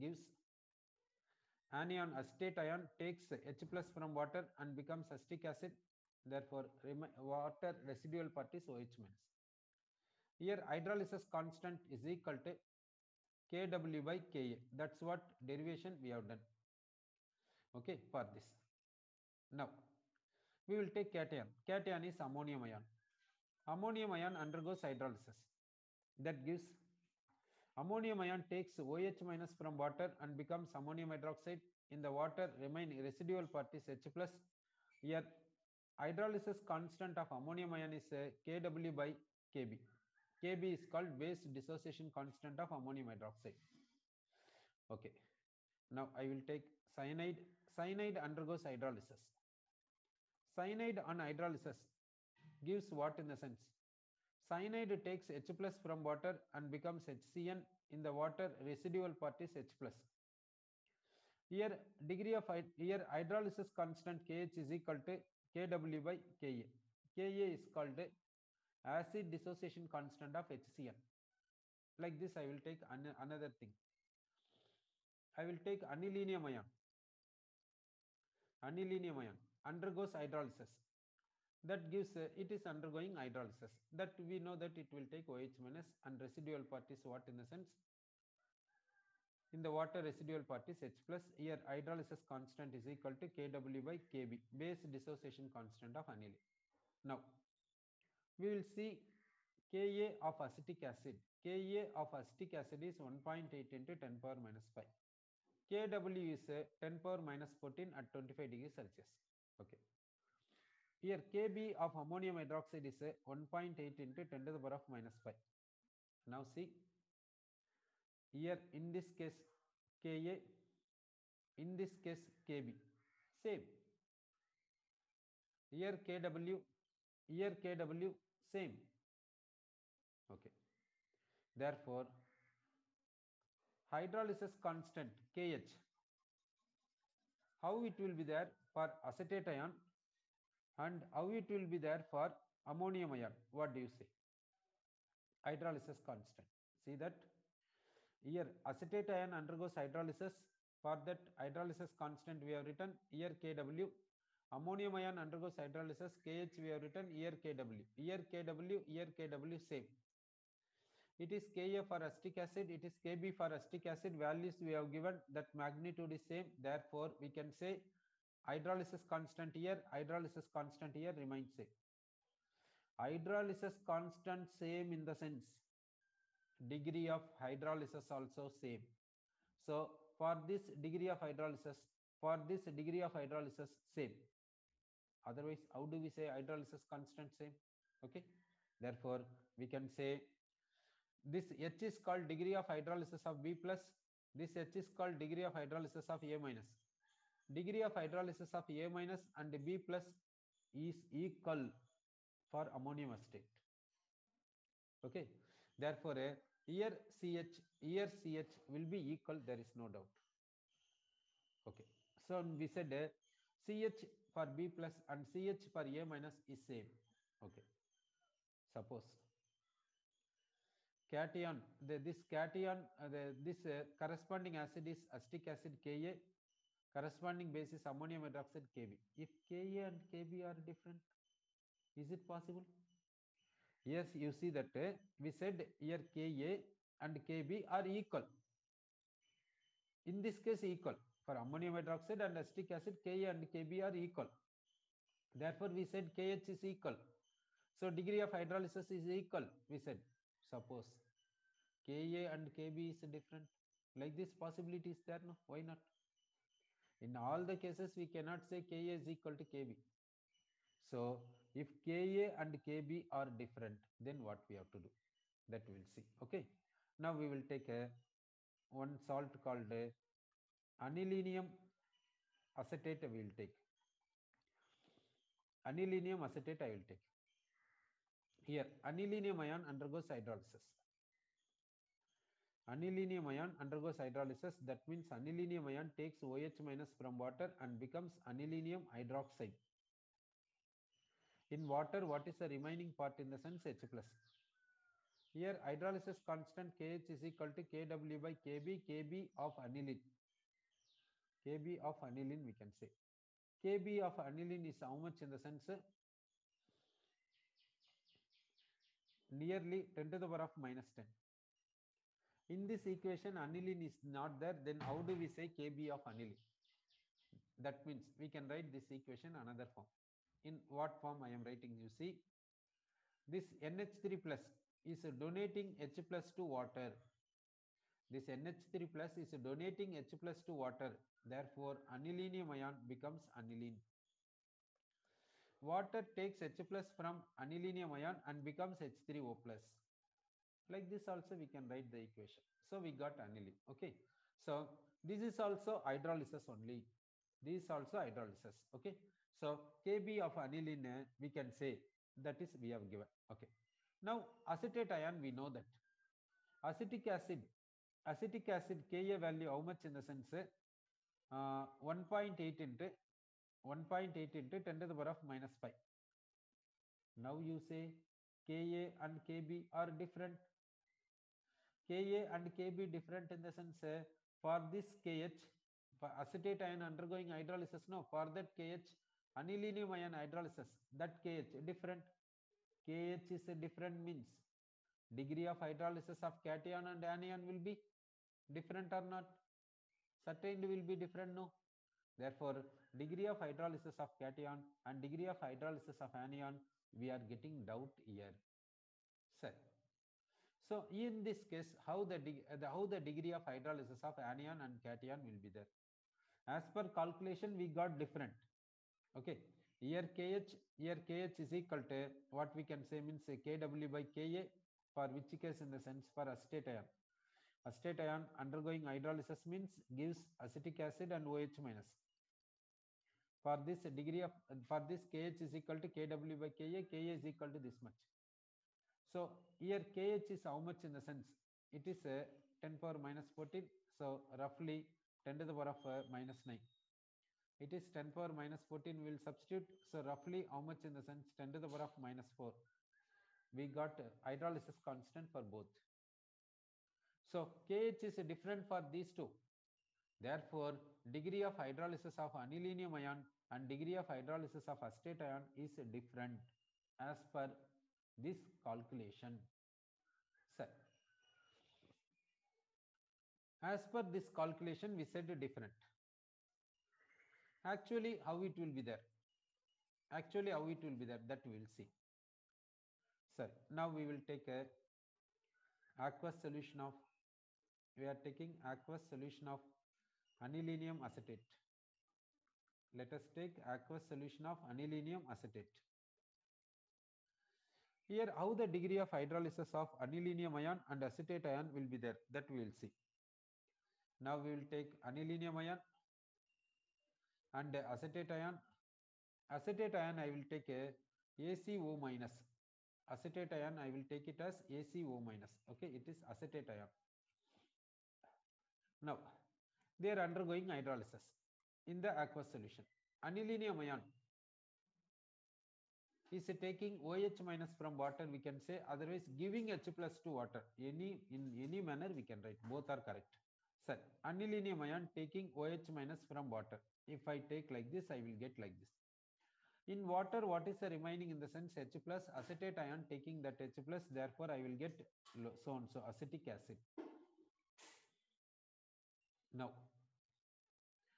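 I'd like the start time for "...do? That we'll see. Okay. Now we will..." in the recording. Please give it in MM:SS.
04:24.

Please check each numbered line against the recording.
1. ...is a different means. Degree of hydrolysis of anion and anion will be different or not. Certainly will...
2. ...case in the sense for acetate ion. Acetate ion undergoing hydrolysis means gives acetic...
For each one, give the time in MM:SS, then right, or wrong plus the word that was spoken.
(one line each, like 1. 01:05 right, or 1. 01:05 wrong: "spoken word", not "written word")
1. 06:23 wrong: "cation", not "anion"
2. 06:55 right.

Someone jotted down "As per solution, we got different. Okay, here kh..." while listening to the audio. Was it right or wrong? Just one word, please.
wrong.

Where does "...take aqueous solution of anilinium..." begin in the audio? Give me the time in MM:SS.
08:03.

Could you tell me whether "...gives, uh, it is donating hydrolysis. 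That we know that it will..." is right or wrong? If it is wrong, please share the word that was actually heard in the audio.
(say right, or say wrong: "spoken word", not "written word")
wrong: "undergoing", not "donating".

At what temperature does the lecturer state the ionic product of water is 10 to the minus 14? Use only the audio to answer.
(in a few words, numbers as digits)
25 degrees Celsius.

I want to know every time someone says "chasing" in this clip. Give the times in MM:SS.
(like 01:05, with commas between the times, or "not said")
not said.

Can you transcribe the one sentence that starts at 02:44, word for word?
Values we have given that magnitude is same.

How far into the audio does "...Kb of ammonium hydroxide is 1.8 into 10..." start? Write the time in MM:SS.
01:51.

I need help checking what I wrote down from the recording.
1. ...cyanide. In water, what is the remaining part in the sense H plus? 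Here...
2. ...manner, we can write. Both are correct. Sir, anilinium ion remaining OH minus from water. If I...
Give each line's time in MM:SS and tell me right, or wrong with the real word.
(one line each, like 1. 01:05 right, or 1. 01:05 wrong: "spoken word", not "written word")
1. 04:48 wrong: "hydroxide", not "cyanide"
2. 08:41 wrong: "taking", not "remaining".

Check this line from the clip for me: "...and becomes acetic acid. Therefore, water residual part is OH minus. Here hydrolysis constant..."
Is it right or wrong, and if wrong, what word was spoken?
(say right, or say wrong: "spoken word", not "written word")
right.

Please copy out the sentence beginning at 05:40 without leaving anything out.
Like this also we can write the equation.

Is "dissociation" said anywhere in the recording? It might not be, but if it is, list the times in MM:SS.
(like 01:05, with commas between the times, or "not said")
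00:41, 01:09, 01:34.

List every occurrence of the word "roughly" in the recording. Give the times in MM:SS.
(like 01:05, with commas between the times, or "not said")
07:14, 07:20.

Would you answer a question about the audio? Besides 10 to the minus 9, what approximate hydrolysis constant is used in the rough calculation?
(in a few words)
10^-4.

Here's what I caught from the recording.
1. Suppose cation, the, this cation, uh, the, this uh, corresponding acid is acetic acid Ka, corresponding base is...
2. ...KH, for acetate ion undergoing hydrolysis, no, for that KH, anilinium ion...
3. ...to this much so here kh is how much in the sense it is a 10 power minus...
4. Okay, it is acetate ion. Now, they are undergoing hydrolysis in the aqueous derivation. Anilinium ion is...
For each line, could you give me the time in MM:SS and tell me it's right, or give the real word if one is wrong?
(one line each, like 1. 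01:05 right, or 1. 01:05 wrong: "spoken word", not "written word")
1. 03:38 right
2. 06:15 right
3. 07:07 right
4. 08:25 wrong: "solution", not "derivation".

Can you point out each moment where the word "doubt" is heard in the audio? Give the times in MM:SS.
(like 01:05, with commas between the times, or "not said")
03:29, 06:37.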